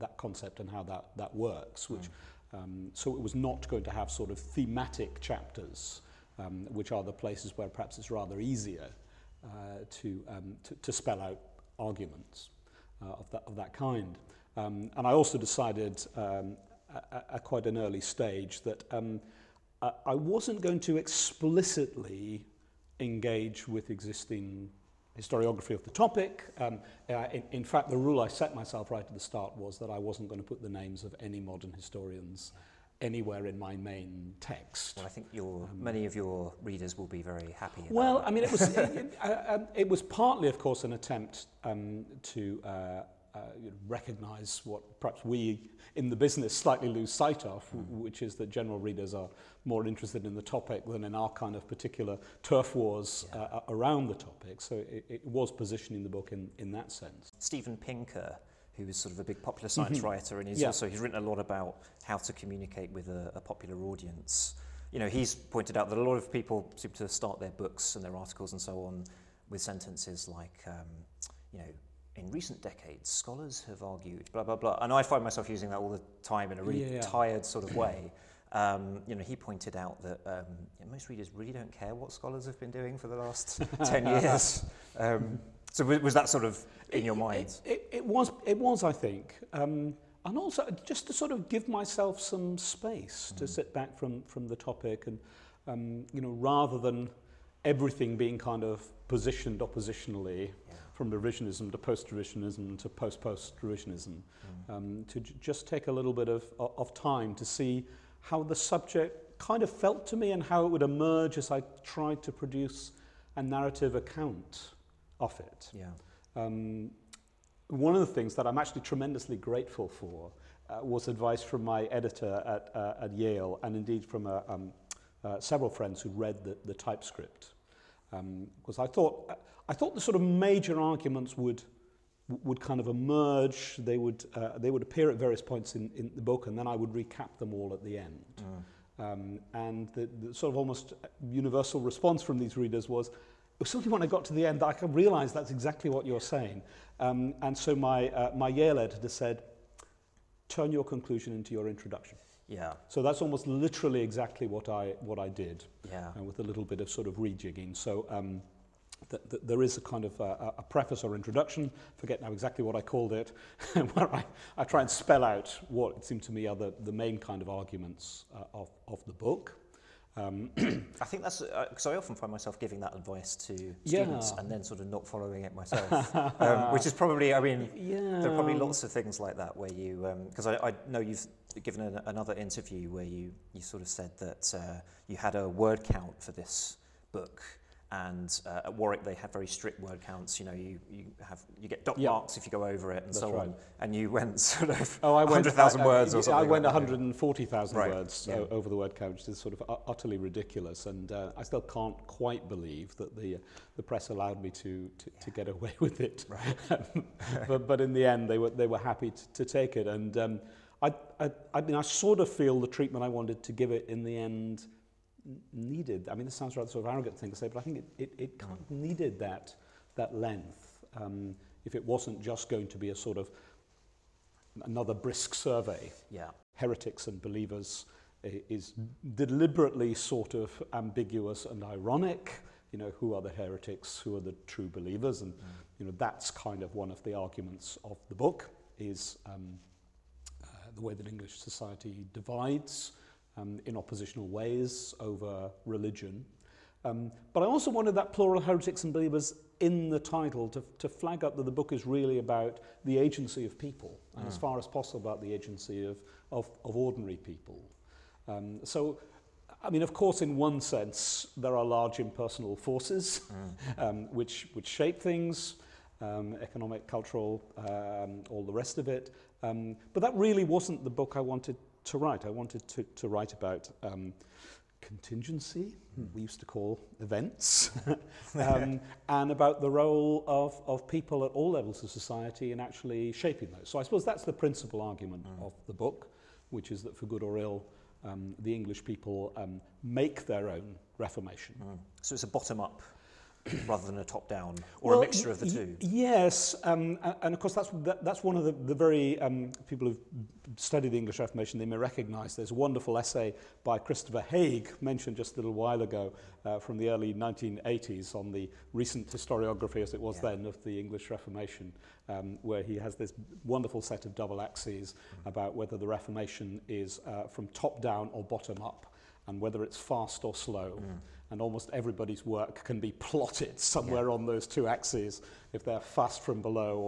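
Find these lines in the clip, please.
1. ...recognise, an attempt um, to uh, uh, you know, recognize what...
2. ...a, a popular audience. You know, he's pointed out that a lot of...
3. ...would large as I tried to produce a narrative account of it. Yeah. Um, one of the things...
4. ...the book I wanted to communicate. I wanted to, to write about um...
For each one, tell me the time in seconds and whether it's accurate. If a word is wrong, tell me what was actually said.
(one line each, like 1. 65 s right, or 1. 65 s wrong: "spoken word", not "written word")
1. 40 s wrong: "course", not "recognise"
2. 63 s right
3. 110 s wrong: "emerge", not "large"
4. 270 s wrong: "write", not "communicate".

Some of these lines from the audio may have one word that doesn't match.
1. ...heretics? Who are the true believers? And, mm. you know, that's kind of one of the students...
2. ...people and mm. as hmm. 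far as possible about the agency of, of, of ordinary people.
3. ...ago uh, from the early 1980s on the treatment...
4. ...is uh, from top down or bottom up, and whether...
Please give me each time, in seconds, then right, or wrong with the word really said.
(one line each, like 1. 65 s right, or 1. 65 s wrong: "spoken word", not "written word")
1. 233 s wrong: "arguments", not "students"
2. 253 s right
3. 305 s wrong: "recent", not "treatment"
4. 316 s right.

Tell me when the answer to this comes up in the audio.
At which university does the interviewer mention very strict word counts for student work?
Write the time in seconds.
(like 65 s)
188 s.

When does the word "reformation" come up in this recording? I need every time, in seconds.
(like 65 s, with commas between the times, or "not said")
290 s, 301 s, 311 s, 315 s.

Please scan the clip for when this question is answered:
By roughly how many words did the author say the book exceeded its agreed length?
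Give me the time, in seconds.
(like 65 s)
196 s.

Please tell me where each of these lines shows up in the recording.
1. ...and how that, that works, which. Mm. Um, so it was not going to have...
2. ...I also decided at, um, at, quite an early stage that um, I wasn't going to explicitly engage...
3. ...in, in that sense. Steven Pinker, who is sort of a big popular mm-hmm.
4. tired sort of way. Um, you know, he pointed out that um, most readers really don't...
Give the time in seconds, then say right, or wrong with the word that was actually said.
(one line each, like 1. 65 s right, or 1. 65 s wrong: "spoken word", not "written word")
1. 0 s right
2. 15 s right
3. 56 s right
4. 77 s right.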